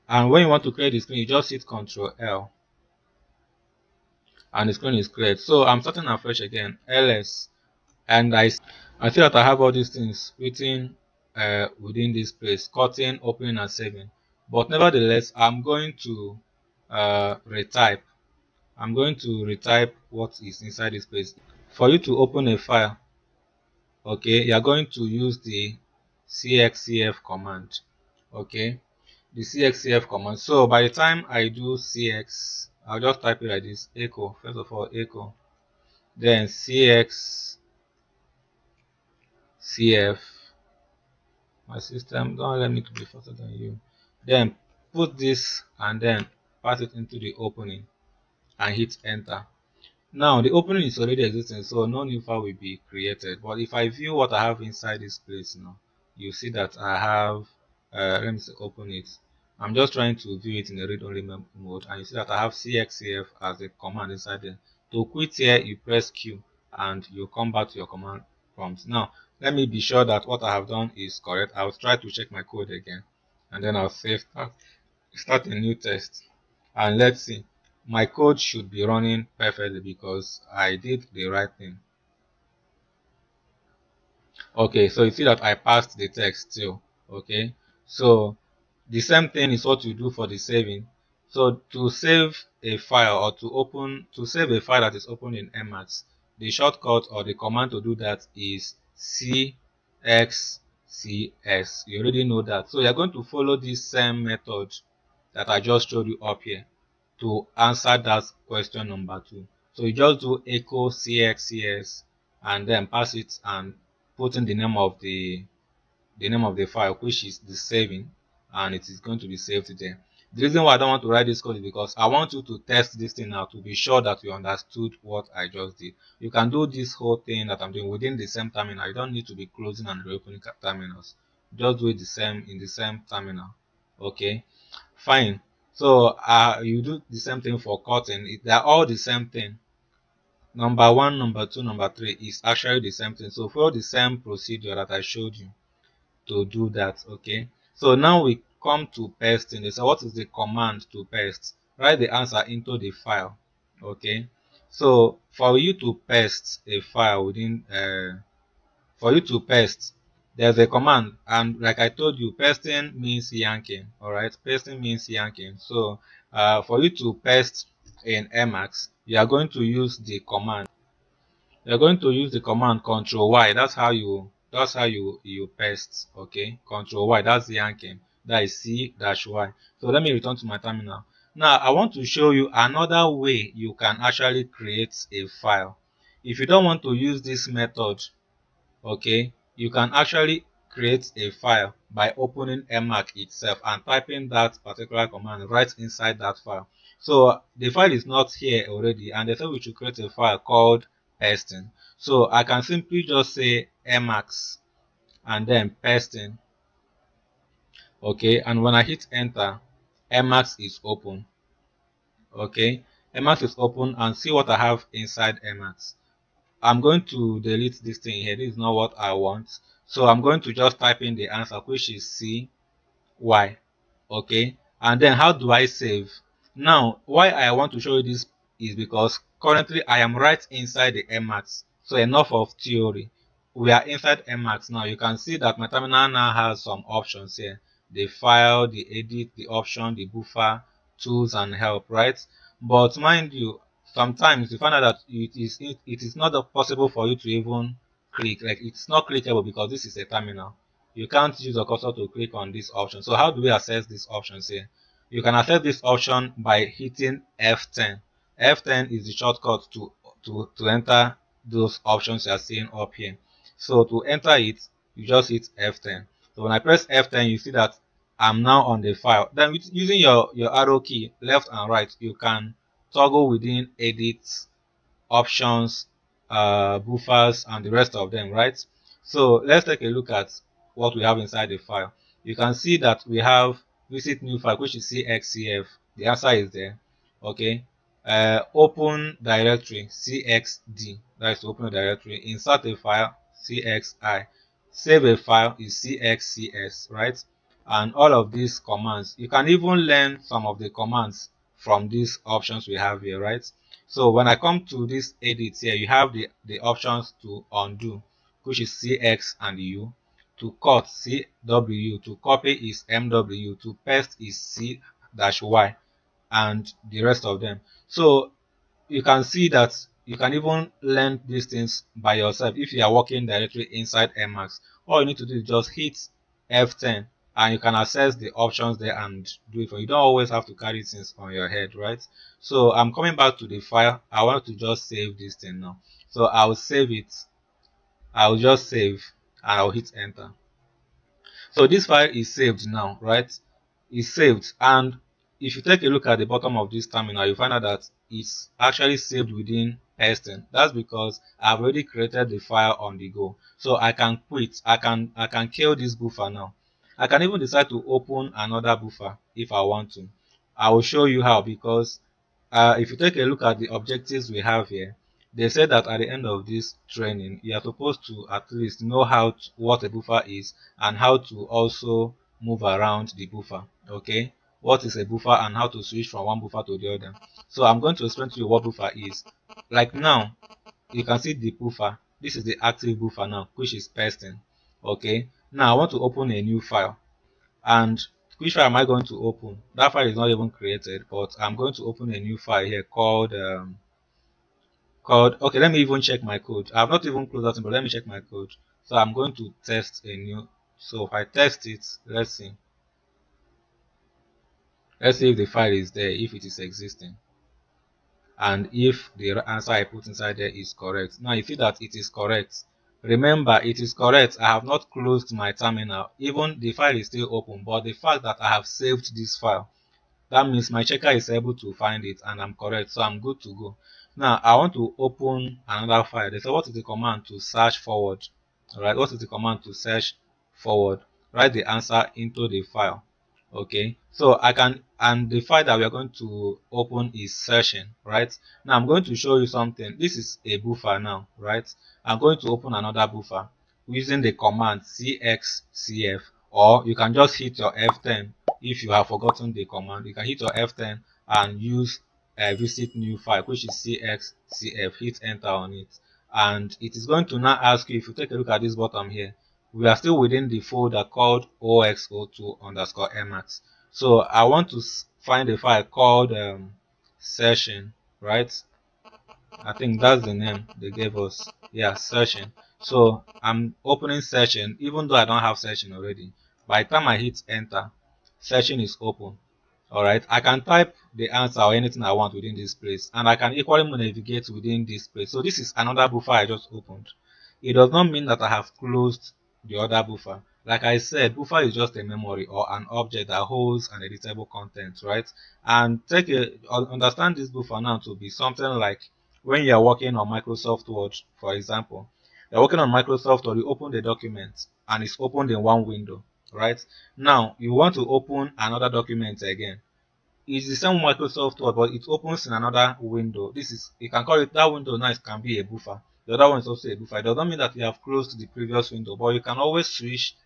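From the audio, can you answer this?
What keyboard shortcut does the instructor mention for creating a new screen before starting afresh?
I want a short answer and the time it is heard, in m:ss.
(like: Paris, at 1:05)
Ctrl L, at 0:01.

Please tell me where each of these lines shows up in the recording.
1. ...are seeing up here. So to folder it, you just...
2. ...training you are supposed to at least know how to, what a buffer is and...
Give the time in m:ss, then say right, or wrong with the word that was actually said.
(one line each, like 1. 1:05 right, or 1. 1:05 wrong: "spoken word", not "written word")
1. 4:22 wrong: "enter", not "folder"
2. 6:06 right.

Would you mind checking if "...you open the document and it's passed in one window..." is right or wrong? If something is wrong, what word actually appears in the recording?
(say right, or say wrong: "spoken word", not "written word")
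wrong: "opened", not "passed".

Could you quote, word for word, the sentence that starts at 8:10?
Like I said, buffer is just a memory or an object that holds an editable content, right?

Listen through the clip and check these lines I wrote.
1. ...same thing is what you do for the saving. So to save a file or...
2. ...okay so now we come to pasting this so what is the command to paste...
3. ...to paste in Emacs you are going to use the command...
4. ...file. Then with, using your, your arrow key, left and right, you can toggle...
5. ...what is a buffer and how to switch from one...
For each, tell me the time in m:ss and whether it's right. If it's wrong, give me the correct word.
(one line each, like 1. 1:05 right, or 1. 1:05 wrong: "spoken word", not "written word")
1. 1:29 right
2. 2:27 right
3. 2:46 right
4. 4:28 right
5. 6:14 right.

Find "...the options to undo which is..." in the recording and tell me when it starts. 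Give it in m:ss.
5:06.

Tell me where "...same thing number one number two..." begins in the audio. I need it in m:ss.
2:18.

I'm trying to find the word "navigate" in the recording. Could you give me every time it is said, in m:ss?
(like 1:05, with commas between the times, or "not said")
8:03.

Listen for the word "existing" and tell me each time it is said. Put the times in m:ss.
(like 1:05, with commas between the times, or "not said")
0:51, 6:46.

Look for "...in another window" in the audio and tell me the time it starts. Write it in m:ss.
8:32.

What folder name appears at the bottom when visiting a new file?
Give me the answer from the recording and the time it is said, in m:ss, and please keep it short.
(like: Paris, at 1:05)
0x02_emacs, at 7:41.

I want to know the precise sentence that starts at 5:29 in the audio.
don't always have to carry things on your head, right?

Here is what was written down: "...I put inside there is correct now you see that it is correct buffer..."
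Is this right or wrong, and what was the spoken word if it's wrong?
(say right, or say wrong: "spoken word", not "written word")
wrong: "remember", not "buffer".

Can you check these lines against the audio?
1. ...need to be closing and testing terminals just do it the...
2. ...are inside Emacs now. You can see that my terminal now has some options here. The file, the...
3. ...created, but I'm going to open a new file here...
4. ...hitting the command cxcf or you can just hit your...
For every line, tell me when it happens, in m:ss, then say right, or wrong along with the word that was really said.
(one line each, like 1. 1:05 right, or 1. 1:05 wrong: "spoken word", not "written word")
1. 2:09 wrong: "reopening", not "testing"
2. 3:53 right
3. 6:30 right
4. 7:23 wrong: "using", not "hitting".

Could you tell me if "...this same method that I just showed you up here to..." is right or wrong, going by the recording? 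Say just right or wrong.
right.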